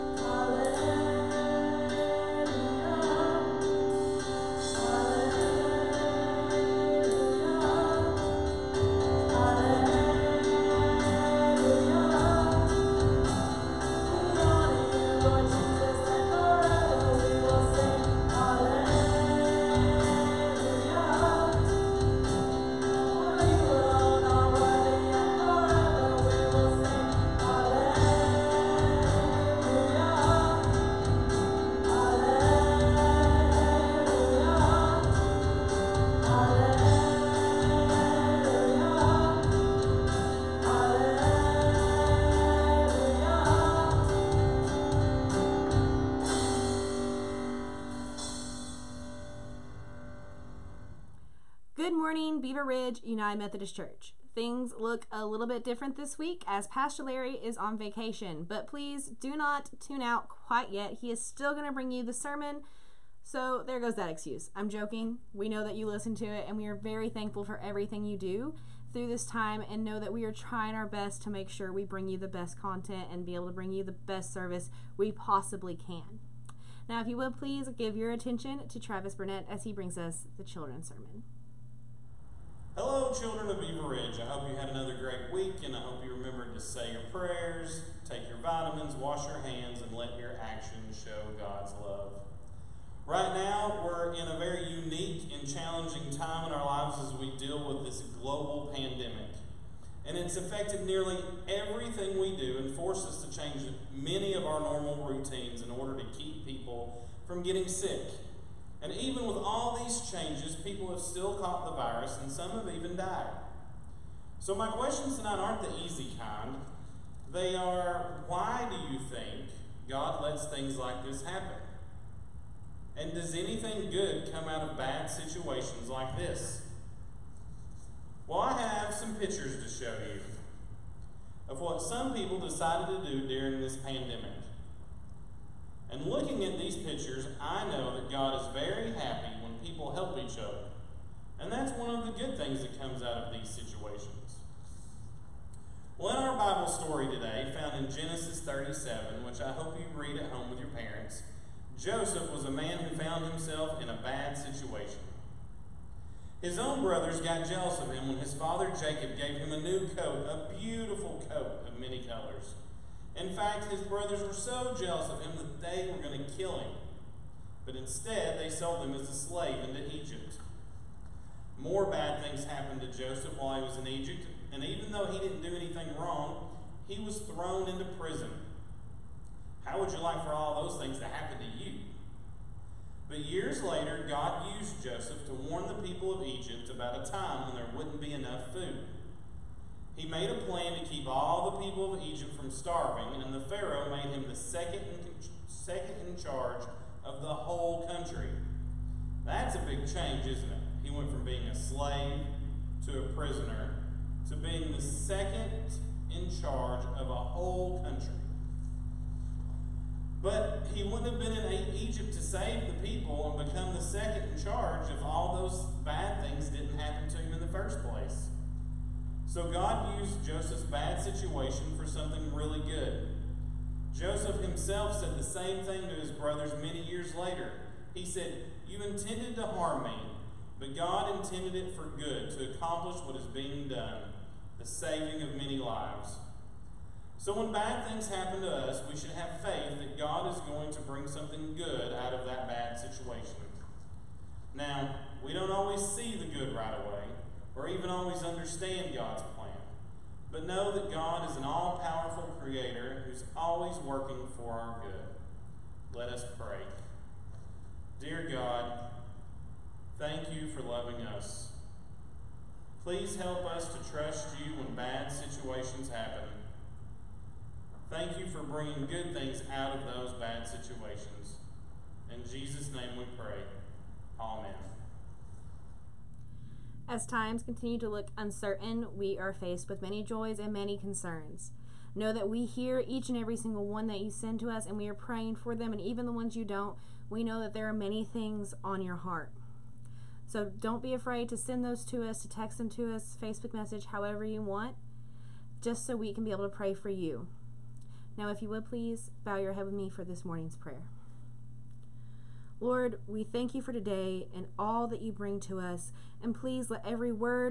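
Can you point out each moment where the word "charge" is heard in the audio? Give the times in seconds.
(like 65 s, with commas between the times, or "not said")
196 s, 206 s, 214 s.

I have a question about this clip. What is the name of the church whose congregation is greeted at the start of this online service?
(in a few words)
Beaver Ridge United Methodist Church.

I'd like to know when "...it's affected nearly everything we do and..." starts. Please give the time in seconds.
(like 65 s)
100 s.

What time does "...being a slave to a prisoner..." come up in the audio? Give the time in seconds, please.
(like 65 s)
201 s.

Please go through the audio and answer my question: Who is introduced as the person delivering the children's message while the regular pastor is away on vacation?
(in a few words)
Travis Burnett.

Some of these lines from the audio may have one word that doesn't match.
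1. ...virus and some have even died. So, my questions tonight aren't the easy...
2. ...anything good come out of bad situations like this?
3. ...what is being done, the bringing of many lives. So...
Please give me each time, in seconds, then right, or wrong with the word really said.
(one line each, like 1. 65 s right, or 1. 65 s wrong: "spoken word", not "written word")
1. 111 s right
2. 123 s right
3. 233 s wrong: "saving", not "bringing".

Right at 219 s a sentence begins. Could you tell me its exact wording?
So God used Joseph's bad situation for something really good.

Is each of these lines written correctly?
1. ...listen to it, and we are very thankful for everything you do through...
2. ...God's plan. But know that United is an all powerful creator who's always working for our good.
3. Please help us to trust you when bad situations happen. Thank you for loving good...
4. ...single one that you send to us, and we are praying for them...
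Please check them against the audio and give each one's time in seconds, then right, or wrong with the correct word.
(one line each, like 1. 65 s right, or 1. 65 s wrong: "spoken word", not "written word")
1. 65 s right
2. 248 s wrong: "God", not "United"
3. 262 s wrong: "bringing", not "loving"
4. 283 s right.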